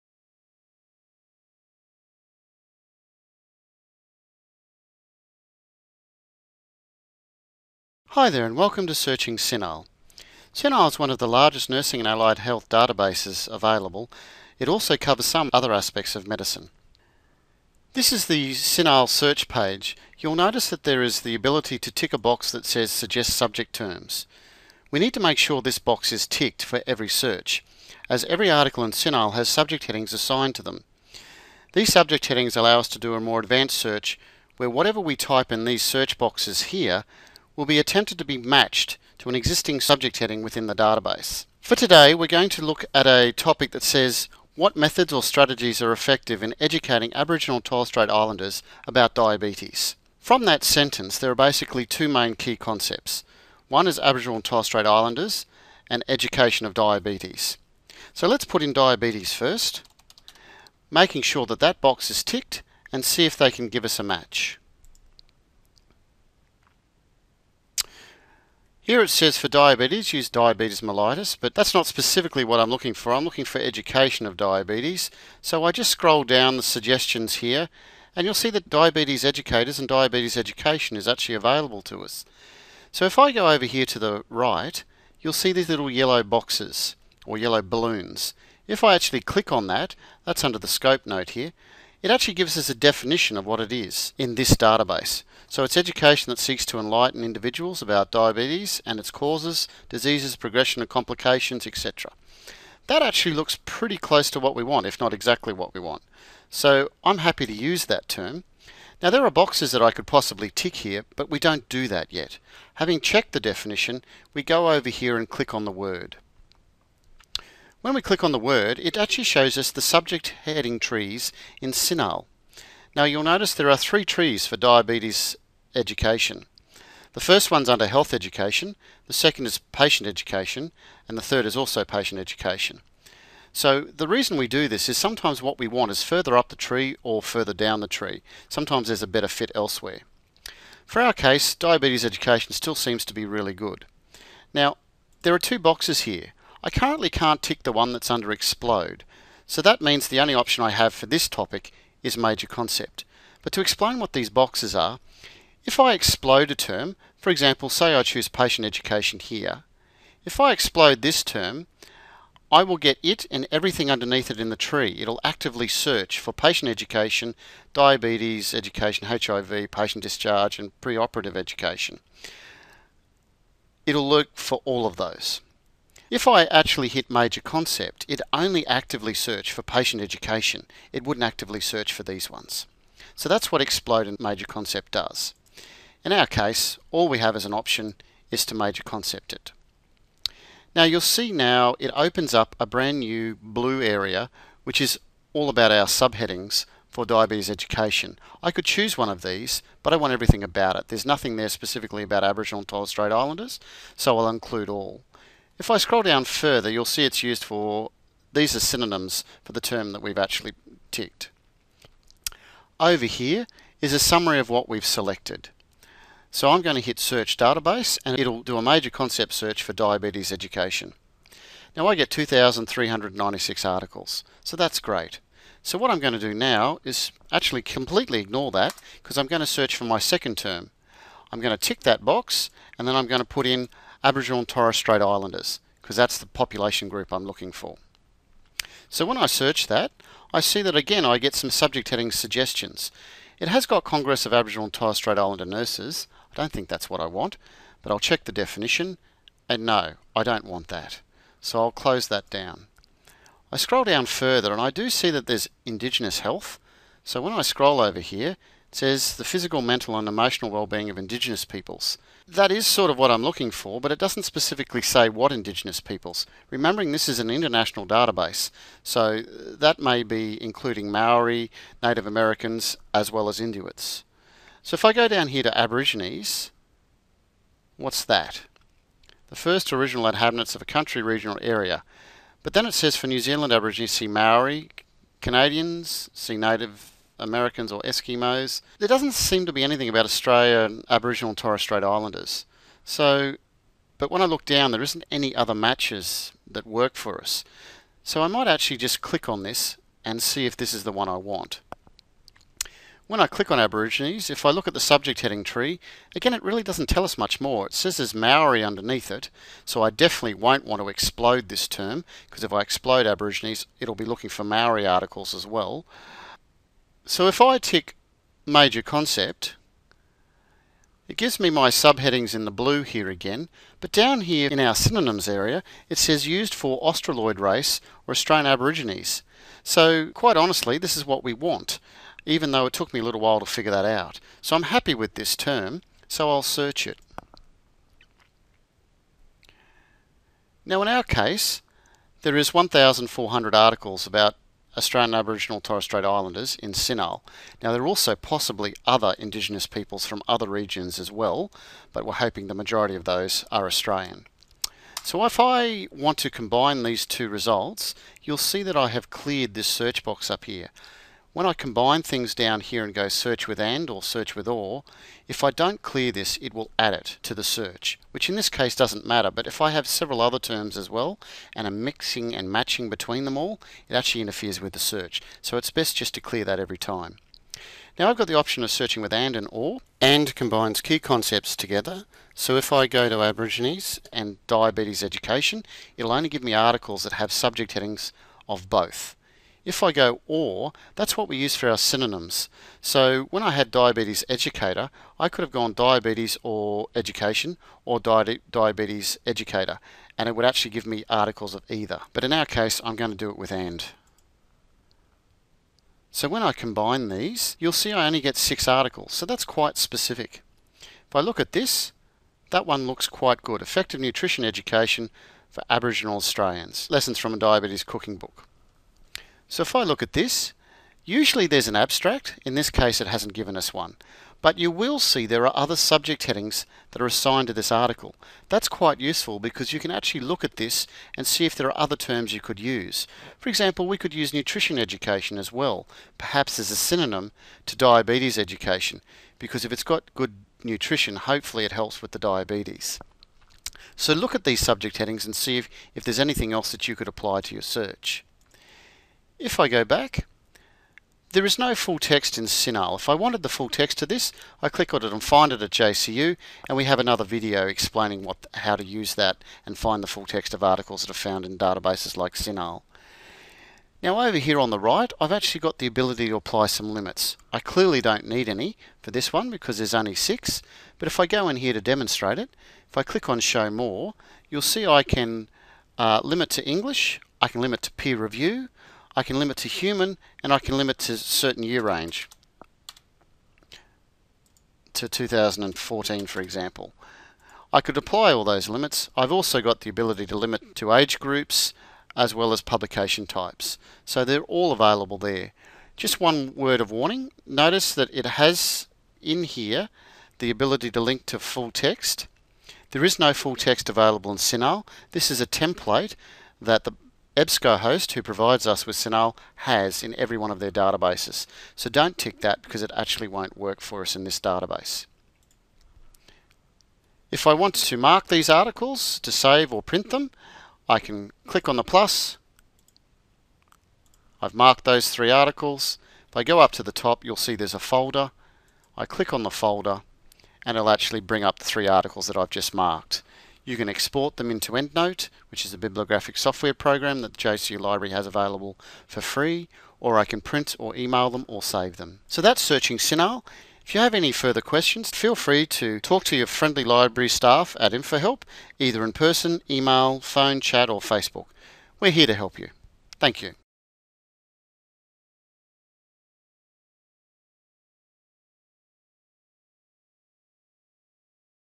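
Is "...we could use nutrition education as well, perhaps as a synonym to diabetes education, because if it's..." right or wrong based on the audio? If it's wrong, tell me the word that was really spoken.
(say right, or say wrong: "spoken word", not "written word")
right.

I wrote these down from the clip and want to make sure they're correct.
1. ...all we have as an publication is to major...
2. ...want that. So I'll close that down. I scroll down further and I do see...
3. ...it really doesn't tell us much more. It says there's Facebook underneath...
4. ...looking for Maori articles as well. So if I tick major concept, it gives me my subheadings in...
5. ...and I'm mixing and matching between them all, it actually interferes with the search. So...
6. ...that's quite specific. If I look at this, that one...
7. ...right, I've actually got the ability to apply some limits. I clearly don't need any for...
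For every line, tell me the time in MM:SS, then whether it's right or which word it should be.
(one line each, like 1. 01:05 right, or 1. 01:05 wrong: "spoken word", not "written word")
1. 03:06 wrong: "option", not "publication"
2. 04:10 right
3. 05:06 wrong: "Maori", not "Facebook"
4. 05:14 right
5. 06:11 right
6. 06:49 right
7. 07:44 right.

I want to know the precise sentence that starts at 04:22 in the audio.
That is sort of what I'm looking for, but it doesn't specifically say what Indigenous peoples.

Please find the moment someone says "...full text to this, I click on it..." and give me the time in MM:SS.
07:33.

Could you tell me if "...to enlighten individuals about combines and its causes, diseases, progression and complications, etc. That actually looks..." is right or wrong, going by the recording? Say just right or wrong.
wrong.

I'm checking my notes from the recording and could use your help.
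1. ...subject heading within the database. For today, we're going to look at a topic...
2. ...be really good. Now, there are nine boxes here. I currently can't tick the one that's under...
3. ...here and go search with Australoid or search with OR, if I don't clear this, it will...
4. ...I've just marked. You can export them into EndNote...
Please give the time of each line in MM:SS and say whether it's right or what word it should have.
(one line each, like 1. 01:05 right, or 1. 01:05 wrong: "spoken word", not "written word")
1. 00:39 right
2. 02:23 wrong: "two", not "nine"
3. 06:02 wrong: "AND", not "Australoid"
4. 08:52 right.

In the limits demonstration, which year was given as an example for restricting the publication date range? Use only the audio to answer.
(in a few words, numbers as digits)
2014.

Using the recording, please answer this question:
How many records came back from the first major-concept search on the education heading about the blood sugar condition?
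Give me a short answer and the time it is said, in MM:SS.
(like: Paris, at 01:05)
2,396, at 03:42.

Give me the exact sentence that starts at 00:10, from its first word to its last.
CINAHL is one of the largest nursing and allied health databases available.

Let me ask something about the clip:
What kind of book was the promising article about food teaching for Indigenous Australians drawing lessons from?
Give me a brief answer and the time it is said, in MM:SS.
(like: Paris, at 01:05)
A diabetes cooking book, at 06:57.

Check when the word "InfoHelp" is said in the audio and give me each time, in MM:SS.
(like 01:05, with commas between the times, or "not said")
09:07.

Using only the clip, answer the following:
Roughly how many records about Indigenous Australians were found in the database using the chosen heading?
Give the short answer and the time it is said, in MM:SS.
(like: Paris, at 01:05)
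1,400, at 05:42.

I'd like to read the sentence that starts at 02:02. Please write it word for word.
Now you'll notice there are three trees for diabetes education.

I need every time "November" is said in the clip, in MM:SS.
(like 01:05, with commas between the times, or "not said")
not said.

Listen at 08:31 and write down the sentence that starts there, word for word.
So don't tick that because it actually won't work for us in this database.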